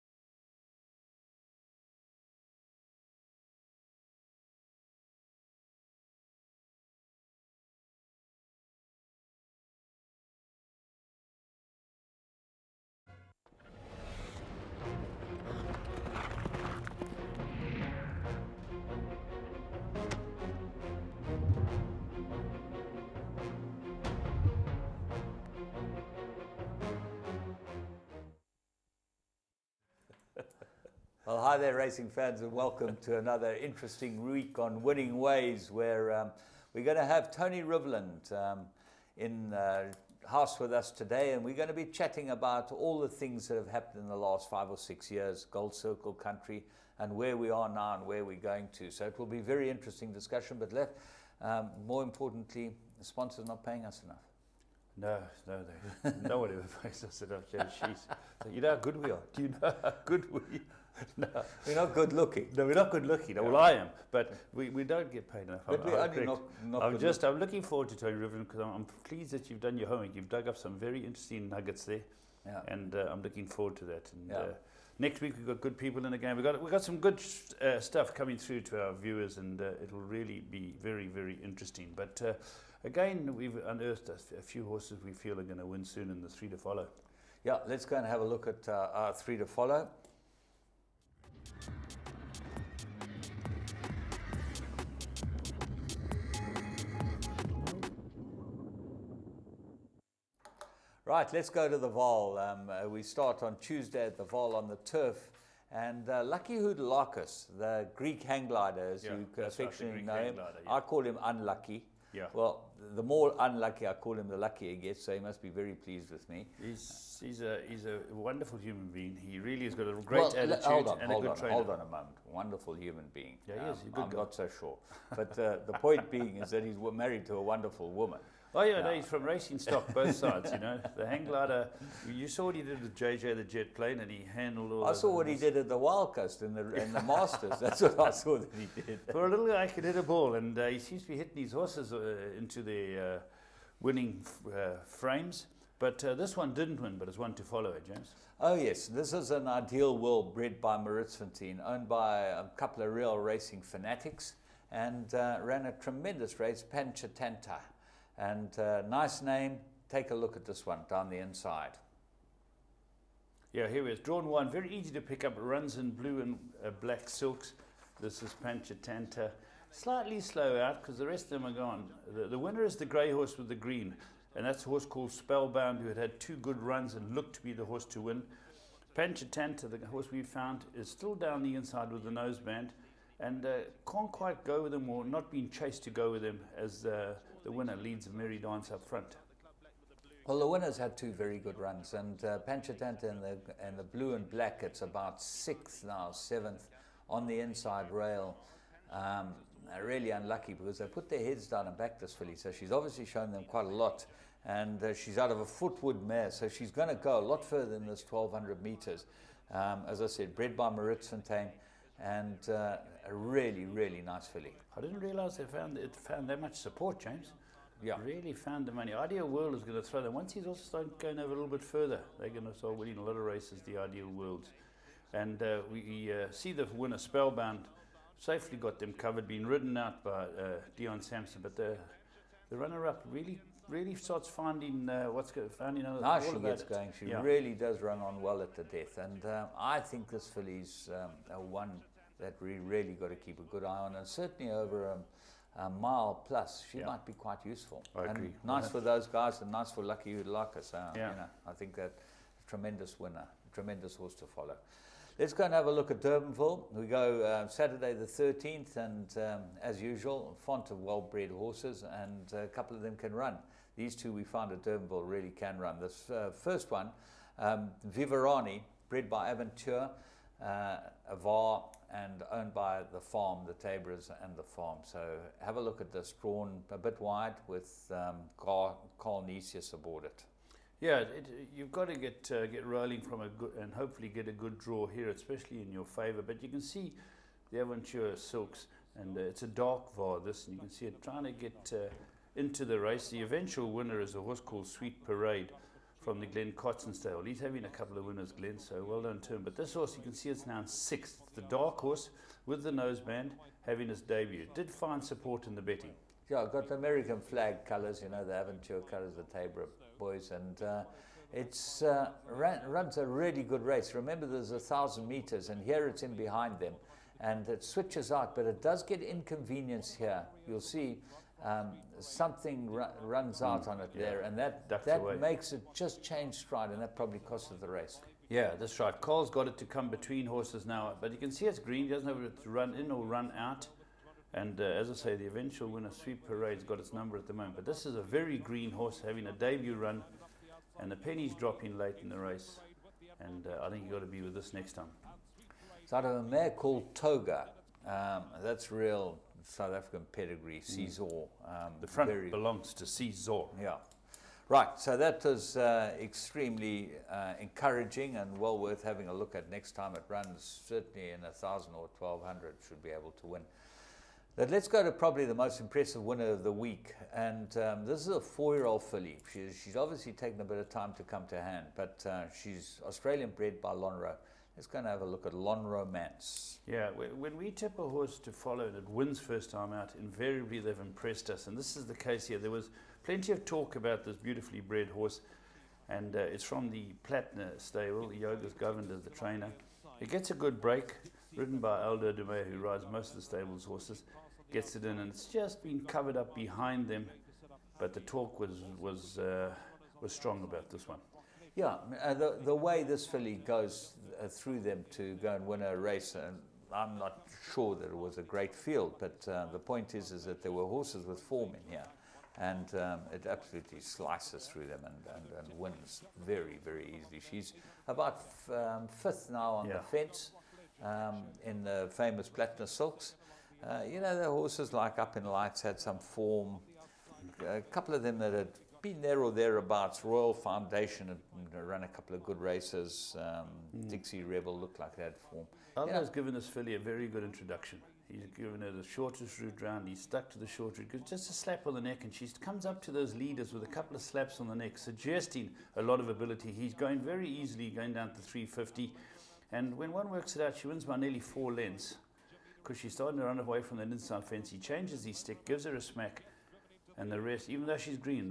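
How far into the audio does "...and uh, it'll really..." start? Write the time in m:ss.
1:19.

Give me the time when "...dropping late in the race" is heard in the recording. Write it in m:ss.
5:41.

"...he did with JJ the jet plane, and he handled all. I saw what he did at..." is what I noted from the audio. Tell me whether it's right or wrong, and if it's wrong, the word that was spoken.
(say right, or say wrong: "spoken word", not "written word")
right.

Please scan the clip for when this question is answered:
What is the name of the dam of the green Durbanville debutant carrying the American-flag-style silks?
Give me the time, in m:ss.
5:46.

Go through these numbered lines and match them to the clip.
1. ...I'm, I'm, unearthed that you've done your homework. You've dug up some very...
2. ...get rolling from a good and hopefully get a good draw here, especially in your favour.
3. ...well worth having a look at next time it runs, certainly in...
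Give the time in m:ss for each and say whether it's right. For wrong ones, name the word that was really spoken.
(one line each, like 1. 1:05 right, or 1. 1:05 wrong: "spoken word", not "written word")
1. 1:08 wrong: "pleased", not "unearthed"
2. 4:42 right
3. 5:58 right.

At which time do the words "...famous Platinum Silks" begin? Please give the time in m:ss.
7:01.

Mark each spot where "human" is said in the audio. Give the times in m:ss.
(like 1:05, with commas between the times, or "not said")
1:58, 2:02.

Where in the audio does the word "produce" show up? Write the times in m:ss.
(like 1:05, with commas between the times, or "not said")
not said.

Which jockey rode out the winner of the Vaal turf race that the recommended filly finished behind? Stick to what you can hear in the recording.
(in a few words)
Dion Sampson.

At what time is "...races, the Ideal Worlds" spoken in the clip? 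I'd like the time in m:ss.
3:43.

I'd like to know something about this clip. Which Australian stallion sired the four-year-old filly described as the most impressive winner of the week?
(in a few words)
Lonhro.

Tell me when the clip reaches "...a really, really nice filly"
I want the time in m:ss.
3:33.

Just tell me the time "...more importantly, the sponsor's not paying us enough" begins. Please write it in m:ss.
0:51.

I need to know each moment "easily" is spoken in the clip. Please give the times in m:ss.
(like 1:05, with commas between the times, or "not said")
6:56, 7:27.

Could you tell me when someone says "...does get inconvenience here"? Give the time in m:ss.
5:18.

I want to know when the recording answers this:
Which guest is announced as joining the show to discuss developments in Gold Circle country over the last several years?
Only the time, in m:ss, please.
0:37.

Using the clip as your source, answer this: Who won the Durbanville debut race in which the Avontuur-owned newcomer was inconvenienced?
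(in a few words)
Sweet Parade.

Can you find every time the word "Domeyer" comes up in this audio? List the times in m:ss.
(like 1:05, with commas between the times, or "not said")
6:32.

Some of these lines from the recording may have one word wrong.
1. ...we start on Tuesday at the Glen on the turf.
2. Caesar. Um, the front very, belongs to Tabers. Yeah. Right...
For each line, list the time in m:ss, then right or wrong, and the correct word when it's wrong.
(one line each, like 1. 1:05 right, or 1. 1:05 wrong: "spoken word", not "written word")
1. 1:42 wrong: "Vaal", not "Glen"
2. 5:50 wrong: "Caesar", not "Tabers".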